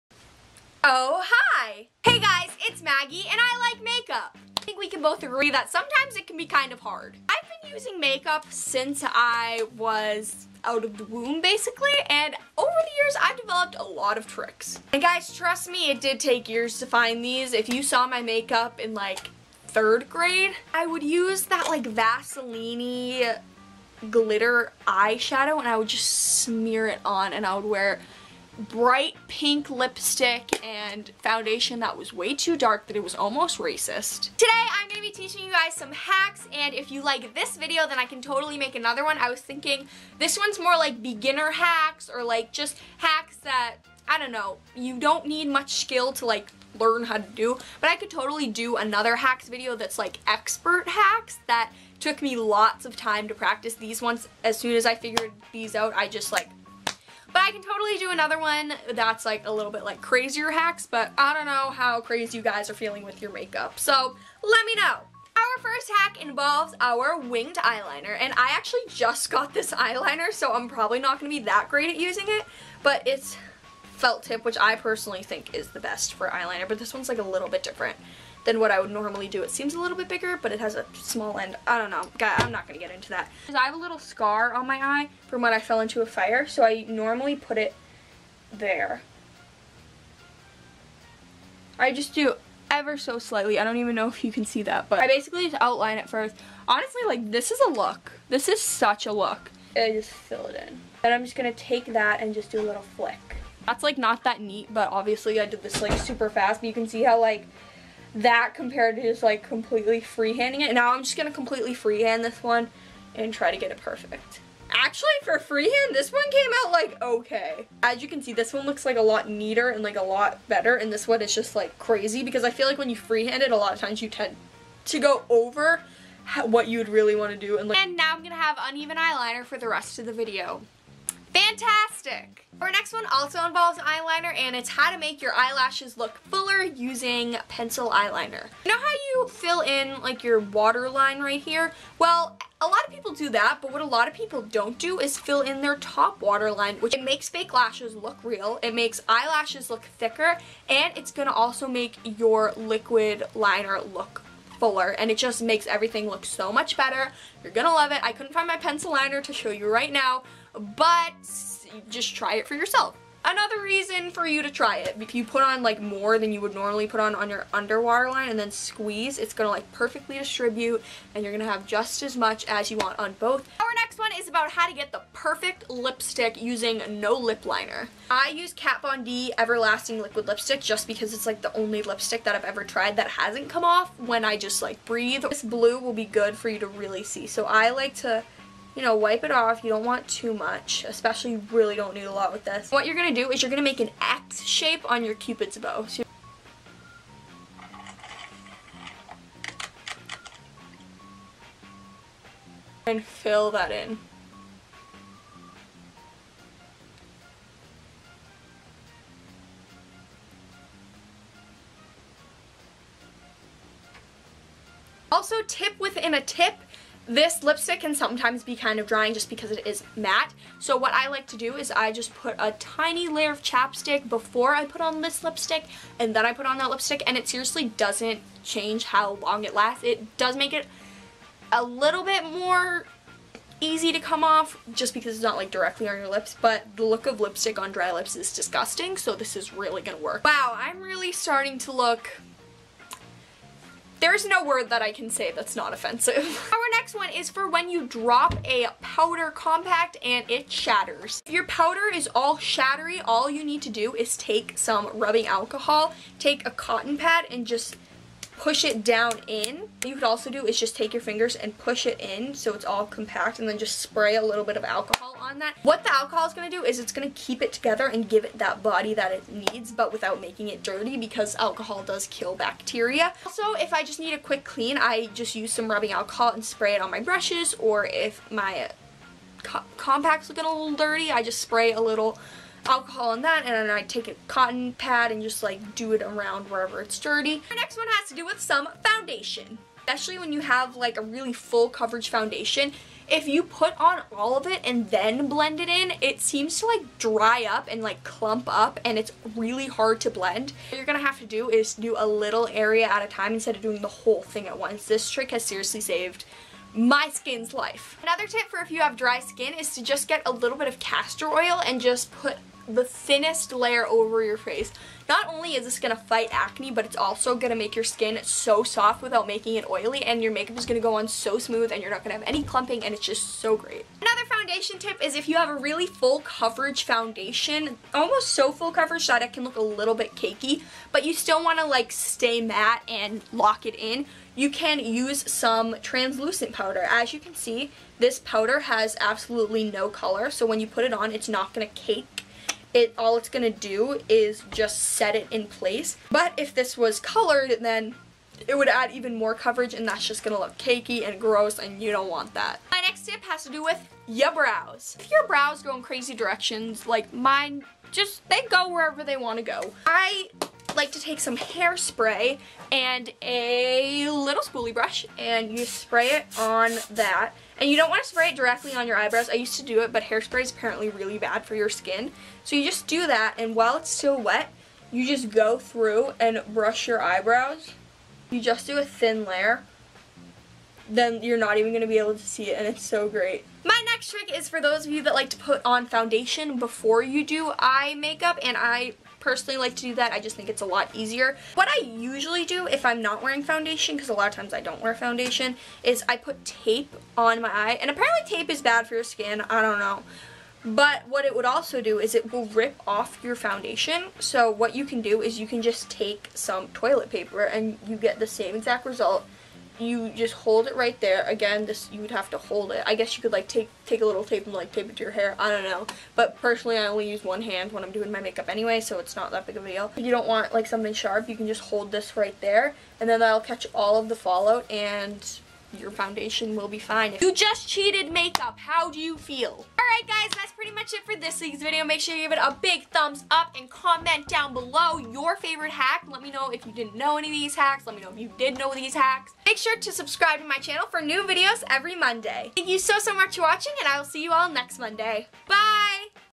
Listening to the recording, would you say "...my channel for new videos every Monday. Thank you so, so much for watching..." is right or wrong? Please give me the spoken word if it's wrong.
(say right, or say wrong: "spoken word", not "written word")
right.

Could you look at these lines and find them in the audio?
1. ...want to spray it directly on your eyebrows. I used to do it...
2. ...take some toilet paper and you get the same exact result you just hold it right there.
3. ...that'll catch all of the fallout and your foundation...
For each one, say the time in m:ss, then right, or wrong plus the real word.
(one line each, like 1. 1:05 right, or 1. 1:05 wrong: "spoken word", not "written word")
1. 6:07 right
2. 6:45 right
3. 7:03 right.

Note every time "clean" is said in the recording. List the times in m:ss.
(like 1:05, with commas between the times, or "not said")
4:34.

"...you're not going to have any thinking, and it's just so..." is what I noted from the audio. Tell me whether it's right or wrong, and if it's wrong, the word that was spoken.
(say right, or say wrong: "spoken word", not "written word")
wrong: "clumping", not "thinking".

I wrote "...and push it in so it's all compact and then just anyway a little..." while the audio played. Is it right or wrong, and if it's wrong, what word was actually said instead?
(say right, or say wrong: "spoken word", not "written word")
wrong: "spray", not "anyway".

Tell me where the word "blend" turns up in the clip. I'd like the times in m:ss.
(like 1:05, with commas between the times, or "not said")
4:55, 5:00.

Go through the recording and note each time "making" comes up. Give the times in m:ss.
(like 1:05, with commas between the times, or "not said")
4:30, 5:19.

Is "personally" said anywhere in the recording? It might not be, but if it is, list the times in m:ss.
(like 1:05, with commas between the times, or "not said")
1:14, 6:29, 6:56.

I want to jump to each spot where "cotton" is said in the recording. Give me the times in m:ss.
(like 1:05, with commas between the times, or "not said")
4:16, 4:44.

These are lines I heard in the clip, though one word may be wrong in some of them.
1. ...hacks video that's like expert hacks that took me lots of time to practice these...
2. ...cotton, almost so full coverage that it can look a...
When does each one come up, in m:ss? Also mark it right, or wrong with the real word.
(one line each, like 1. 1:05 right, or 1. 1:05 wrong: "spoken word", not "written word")
1. 0:49 right
2. 5:26 wrong: "foundation", not "cotton".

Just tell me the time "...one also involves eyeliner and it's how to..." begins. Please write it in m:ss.
2:12.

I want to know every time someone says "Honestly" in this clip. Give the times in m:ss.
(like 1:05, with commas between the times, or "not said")
1:36.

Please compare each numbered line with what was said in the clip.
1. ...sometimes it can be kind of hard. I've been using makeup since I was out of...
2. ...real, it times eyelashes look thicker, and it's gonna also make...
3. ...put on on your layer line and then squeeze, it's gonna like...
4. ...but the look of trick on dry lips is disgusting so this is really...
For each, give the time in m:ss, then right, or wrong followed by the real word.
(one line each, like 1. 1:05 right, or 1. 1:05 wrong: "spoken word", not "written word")
1. 0:05 right
2. 2:28 wrong: "makes", not "times"
3. 2:46 wrong: "underwater", not "layer"
4. 3:56 wrong: "lipstick", not "trick".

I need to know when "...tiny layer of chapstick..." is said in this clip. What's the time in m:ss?
3:42.